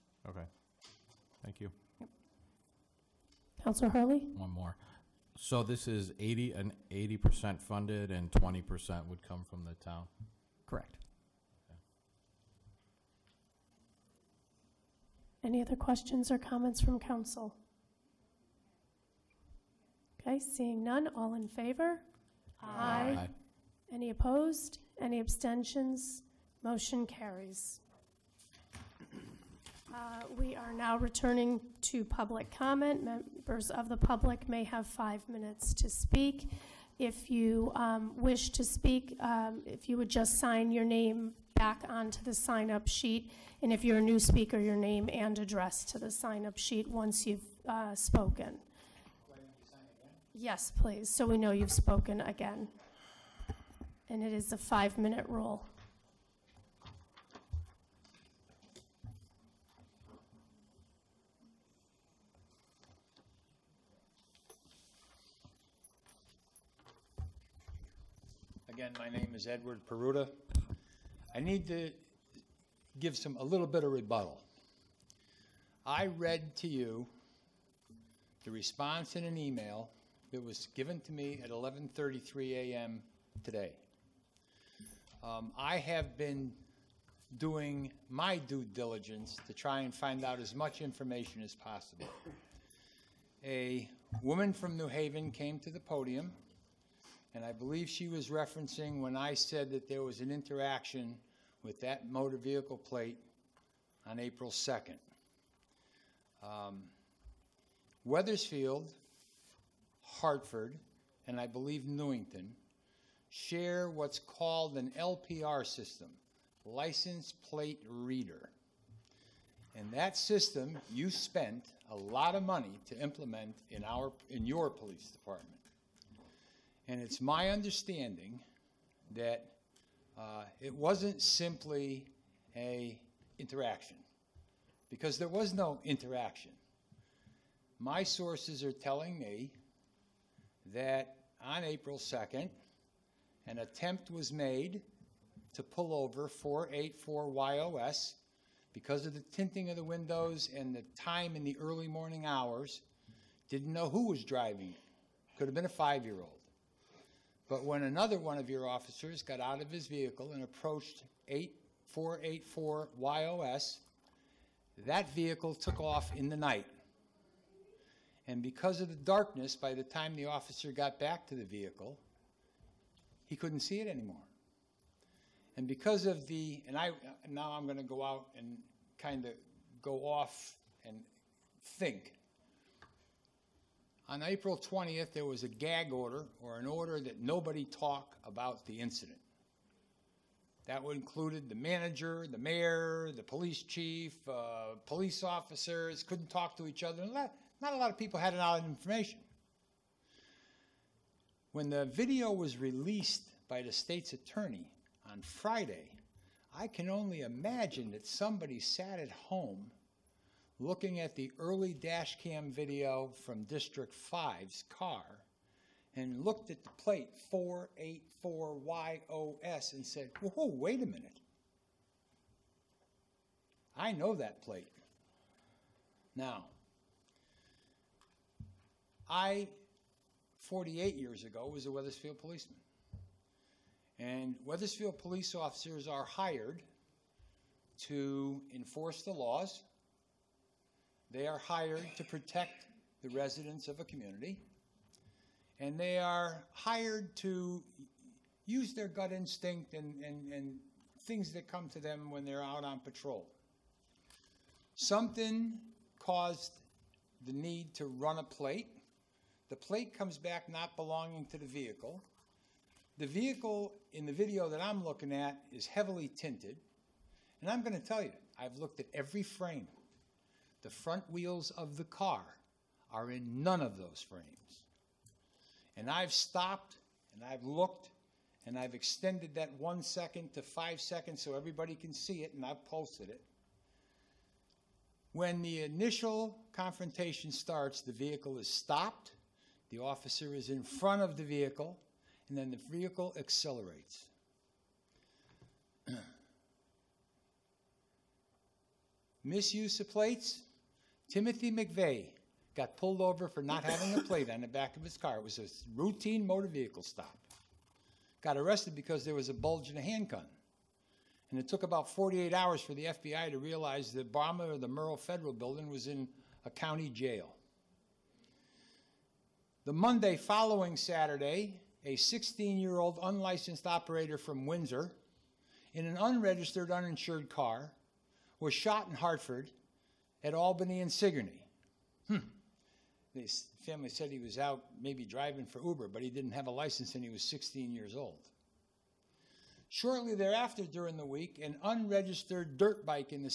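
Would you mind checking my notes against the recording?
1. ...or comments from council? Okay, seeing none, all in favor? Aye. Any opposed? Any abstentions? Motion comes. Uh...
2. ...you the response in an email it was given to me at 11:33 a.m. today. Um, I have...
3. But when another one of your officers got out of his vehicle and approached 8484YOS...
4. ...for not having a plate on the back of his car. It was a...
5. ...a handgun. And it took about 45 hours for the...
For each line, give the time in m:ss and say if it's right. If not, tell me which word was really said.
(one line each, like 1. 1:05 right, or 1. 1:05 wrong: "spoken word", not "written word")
1. 0:16 wrong: "carries", not "comes"
2. 1:16 right
3. 2:37 right
4. 5:03 right
5. 5:09 wrong: "48", not "45".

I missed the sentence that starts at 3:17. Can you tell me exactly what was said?
And that, not a lot of people had a lot of information.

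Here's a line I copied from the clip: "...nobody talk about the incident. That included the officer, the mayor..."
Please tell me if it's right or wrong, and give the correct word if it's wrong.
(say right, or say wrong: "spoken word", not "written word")
wrong: "manager", not "officer".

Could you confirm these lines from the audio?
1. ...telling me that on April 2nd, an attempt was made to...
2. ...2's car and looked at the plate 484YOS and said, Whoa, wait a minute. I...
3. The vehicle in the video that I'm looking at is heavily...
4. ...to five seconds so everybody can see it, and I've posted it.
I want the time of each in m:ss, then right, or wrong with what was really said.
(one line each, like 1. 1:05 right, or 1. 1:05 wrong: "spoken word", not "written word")
1. 2:18 right
2. 3:34 wrong: "5", not "2"
3. 4:22 right
4. 4:40 right.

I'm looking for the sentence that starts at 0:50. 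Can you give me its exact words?
Yes, please, so we know you've spoken again.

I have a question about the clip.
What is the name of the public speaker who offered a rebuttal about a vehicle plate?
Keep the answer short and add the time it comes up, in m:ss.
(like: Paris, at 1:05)
Edward Peruta, at 1:09.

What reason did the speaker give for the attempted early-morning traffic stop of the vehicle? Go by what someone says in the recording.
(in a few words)
tinting of the windows.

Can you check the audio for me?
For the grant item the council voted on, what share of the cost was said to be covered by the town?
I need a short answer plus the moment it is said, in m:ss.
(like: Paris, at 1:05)
20%, at 0:08.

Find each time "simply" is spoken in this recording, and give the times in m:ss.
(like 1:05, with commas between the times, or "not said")
2:11.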